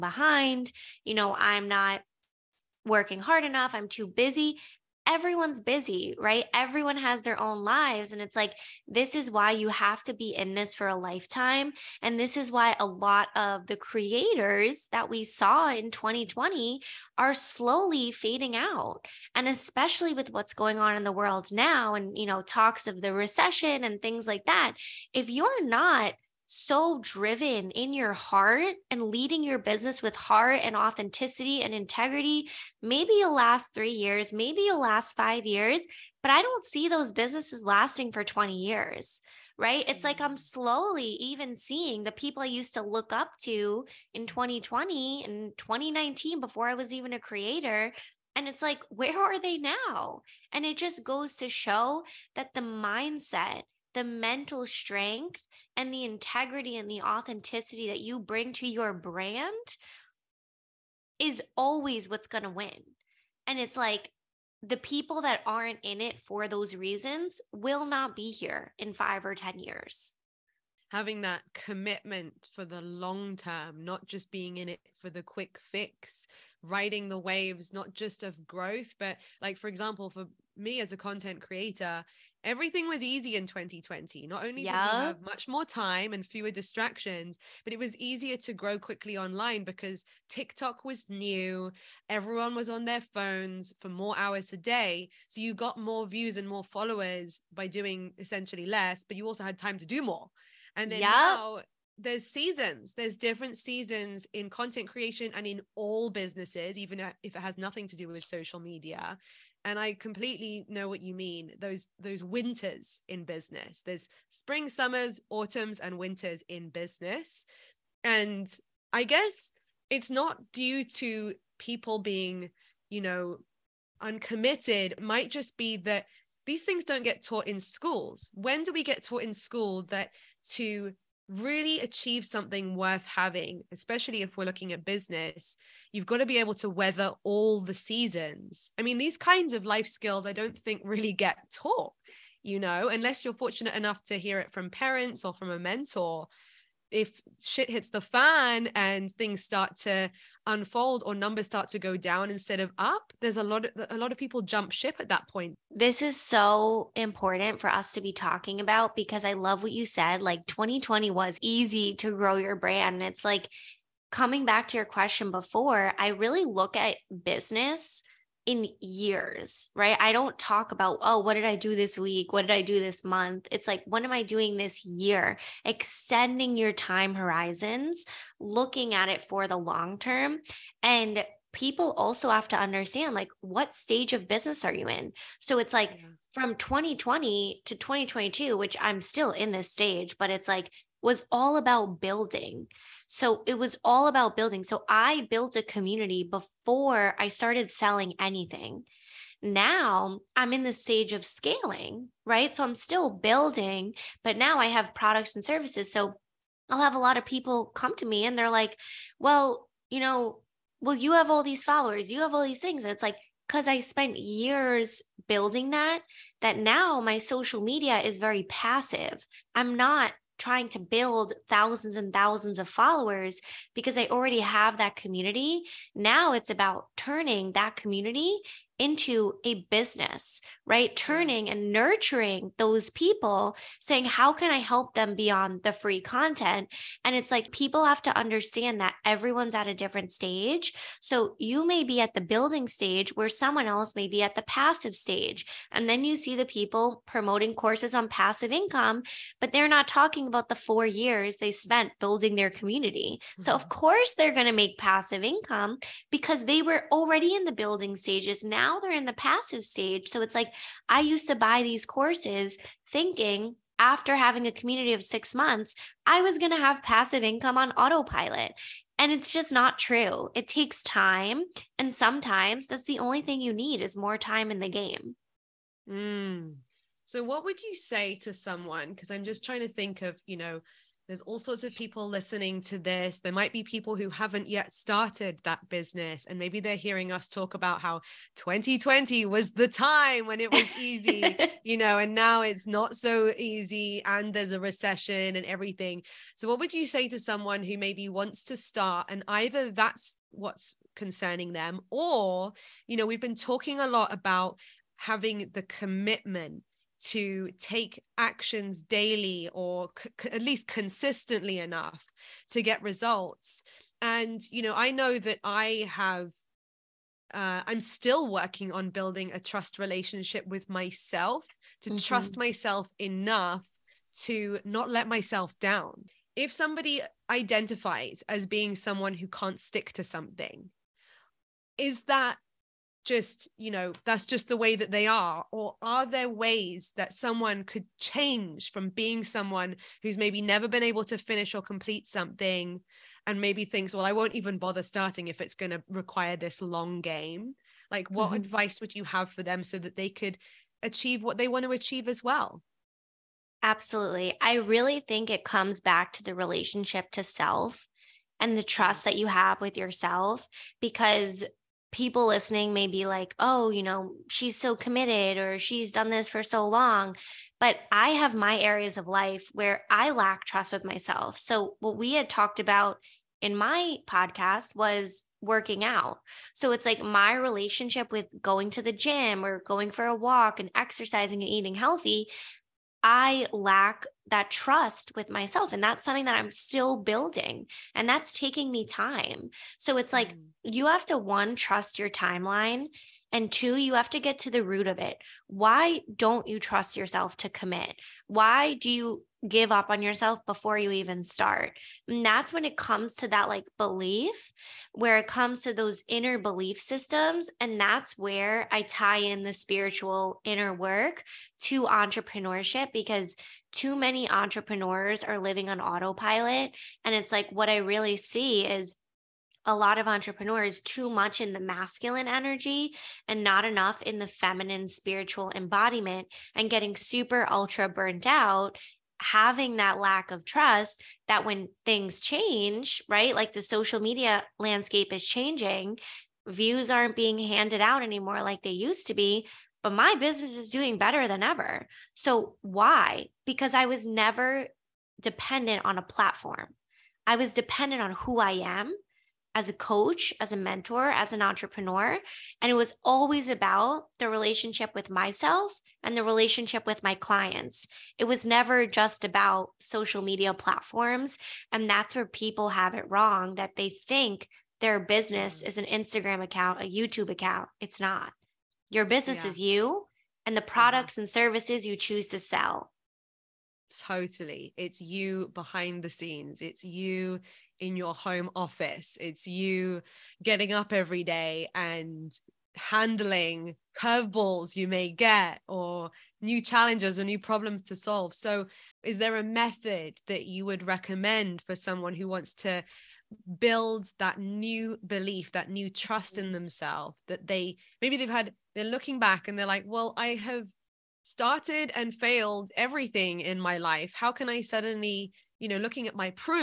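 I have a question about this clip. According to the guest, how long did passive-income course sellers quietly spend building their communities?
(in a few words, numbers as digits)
4 years.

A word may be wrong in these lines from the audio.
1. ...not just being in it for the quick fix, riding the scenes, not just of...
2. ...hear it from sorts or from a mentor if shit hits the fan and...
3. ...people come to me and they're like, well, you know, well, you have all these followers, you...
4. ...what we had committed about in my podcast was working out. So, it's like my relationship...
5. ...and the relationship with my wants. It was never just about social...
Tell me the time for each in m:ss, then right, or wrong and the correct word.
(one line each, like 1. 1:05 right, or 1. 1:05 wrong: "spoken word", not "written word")
1. 1:13 wrong: "waves", not "scenes"
2. 2:24 wrong: "parents", not "sorts"
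3. 3:27 right
4. 6:11 wrong: "talked", not "committed"
5. 7:36 wrong: "clients", not "wants".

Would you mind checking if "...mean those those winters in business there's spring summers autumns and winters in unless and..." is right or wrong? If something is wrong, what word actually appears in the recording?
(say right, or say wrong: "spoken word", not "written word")
wrong: "business", not "unless".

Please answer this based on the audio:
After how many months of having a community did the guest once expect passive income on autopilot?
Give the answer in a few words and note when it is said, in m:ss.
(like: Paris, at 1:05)
6 months, at 4:25.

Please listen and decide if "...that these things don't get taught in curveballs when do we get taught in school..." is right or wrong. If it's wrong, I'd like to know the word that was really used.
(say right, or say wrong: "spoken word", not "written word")
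wrong: "schools", not "curveballs".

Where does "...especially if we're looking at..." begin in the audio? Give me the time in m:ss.
2:13.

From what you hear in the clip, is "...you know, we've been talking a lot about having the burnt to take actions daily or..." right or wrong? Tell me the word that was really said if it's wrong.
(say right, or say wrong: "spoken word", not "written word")
wrong: "commitment", not "burnt".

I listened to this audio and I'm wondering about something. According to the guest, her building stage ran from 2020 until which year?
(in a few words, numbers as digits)
2022.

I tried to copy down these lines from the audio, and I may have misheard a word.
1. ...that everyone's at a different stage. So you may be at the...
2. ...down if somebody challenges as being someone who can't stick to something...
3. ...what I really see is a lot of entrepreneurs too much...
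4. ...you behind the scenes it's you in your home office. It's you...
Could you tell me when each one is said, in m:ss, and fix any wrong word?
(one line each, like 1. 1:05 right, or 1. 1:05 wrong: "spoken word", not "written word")
1. 3:58 right
2. 5:25 wrong: "identifies", not "challenges"
3. 6:57 right
4. 7:54 right.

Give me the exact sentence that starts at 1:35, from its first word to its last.
So you got more views and more followers by doing essentially less, but you also had time to do more.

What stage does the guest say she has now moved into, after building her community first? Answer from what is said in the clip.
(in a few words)
scaling.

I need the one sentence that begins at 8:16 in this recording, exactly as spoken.
themselves that they maybe they've had, they're looking back and they're like, well, I have started and failed everything in my life.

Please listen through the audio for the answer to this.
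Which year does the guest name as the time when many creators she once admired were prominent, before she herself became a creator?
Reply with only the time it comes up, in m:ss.
0:45.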